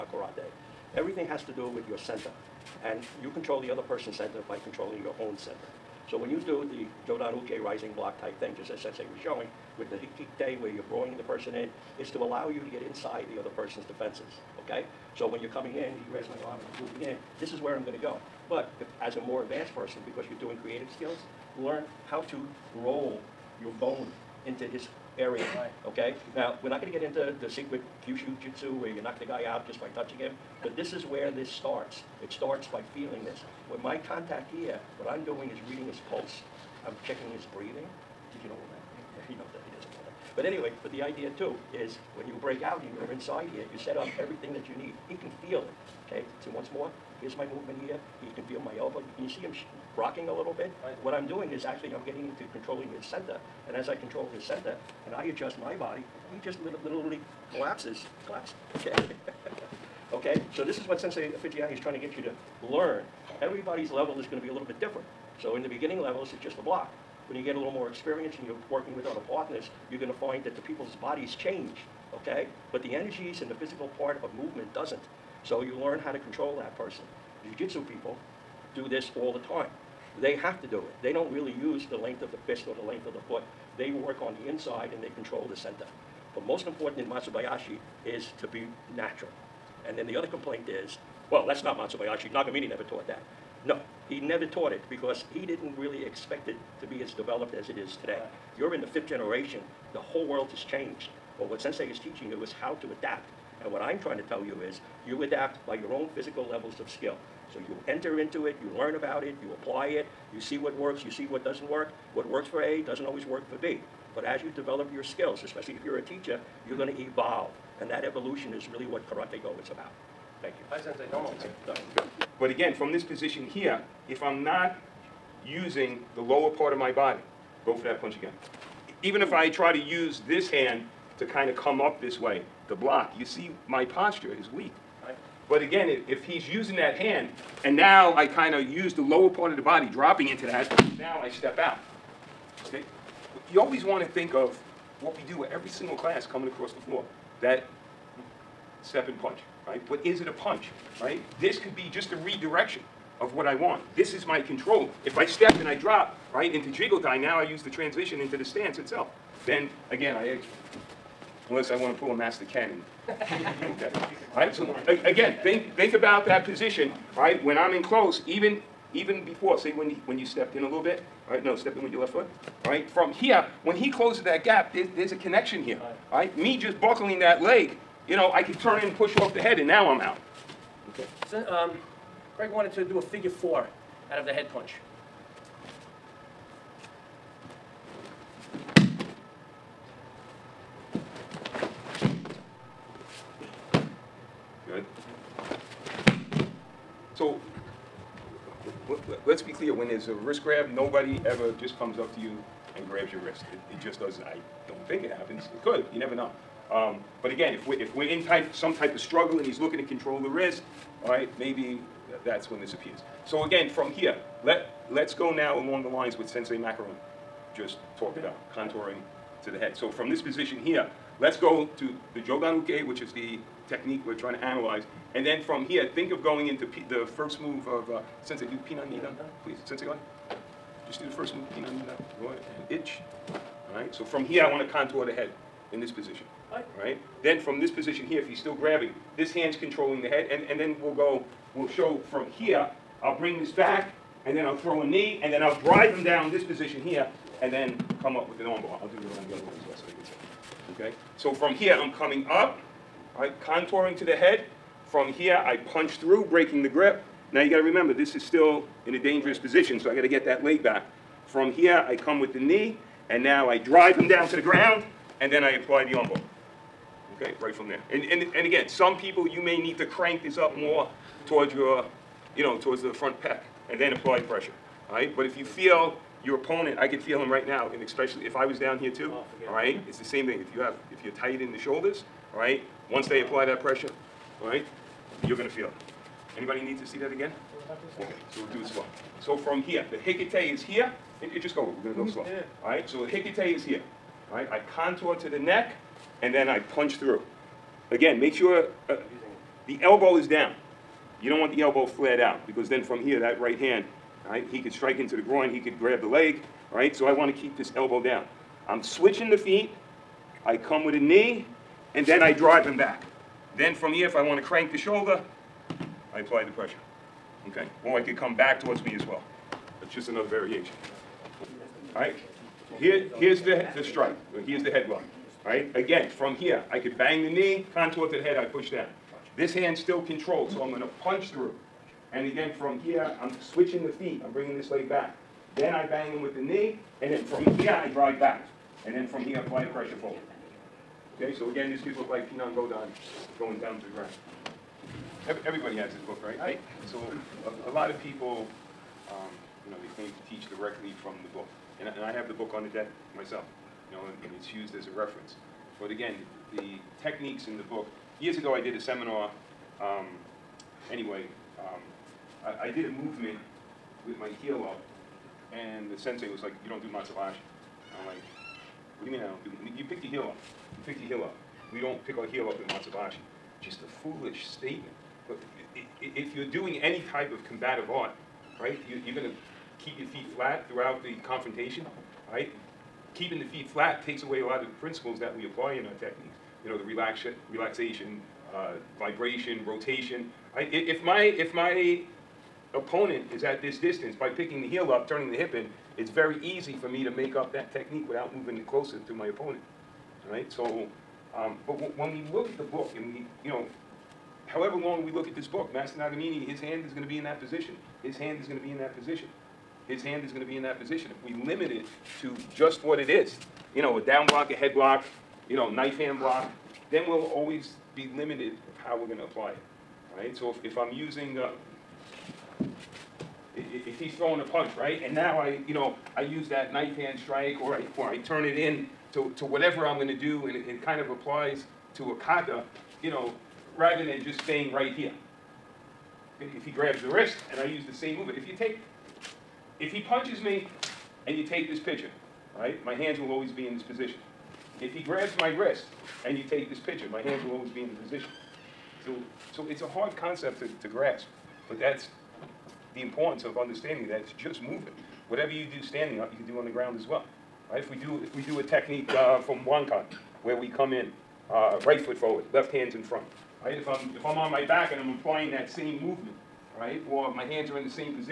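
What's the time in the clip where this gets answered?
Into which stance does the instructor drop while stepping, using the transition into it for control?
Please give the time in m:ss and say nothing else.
2:36.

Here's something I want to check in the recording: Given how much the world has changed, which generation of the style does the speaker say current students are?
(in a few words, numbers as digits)
Fifth.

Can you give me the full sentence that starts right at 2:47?
When I'm in close, even, even before, say when you, when you stepped in a little bit, right?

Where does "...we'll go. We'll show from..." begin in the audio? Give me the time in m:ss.
4:00.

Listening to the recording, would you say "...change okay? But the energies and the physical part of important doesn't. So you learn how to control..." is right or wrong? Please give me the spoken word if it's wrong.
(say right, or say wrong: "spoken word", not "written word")
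wrong: "movement", not "important".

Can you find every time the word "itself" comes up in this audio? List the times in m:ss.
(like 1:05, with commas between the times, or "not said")
2:38.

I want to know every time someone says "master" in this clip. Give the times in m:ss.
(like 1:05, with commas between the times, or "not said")
2:42, 6:45.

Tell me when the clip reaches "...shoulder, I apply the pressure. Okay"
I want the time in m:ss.
5:14.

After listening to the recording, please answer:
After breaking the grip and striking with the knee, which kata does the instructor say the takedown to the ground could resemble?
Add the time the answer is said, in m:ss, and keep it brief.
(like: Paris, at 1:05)
Pinan Godan, at 5:42.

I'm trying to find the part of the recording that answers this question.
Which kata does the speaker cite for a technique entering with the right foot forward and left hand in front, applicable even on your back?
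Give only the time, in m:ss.
7:39.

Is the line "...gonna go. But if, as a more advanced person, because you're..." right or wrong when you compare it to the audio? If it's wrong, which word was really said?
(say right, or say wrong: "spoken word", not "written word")
right.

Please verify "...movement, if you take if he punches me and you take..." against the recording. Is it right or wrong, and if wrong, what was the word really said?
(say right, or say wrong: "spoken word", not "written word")
right.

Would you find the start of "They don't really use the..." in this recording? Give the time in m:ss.
1:21.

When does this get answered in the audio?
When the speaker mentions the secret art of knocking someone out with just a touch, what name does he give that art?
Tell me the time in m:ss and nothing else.
0:28.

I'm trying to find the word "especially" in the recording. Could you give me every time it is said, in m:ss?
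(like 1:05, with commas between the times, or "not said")
1:55, 4:37.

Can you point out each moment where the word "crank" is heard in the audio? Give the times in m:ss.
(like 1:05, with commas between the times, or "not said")
4:29, 5:14.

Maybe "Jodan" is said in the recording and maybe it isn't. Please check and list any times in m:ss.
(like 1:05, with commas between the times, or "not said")
0:07, 3:42.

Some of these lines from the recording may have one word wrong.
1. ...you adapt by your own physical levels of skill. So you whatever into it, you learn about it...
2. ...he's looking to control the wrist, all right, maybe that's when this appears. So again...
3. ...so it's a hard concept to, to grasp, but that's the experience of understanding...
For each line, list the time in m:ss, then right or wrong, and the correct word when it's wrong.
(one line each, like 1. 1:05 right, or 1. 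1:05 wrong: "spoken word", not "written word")
1. 1:45 wrong: "enter", not "whatever"
2. 3:29 right
3. 7:29 wrong: "importance", not "experience".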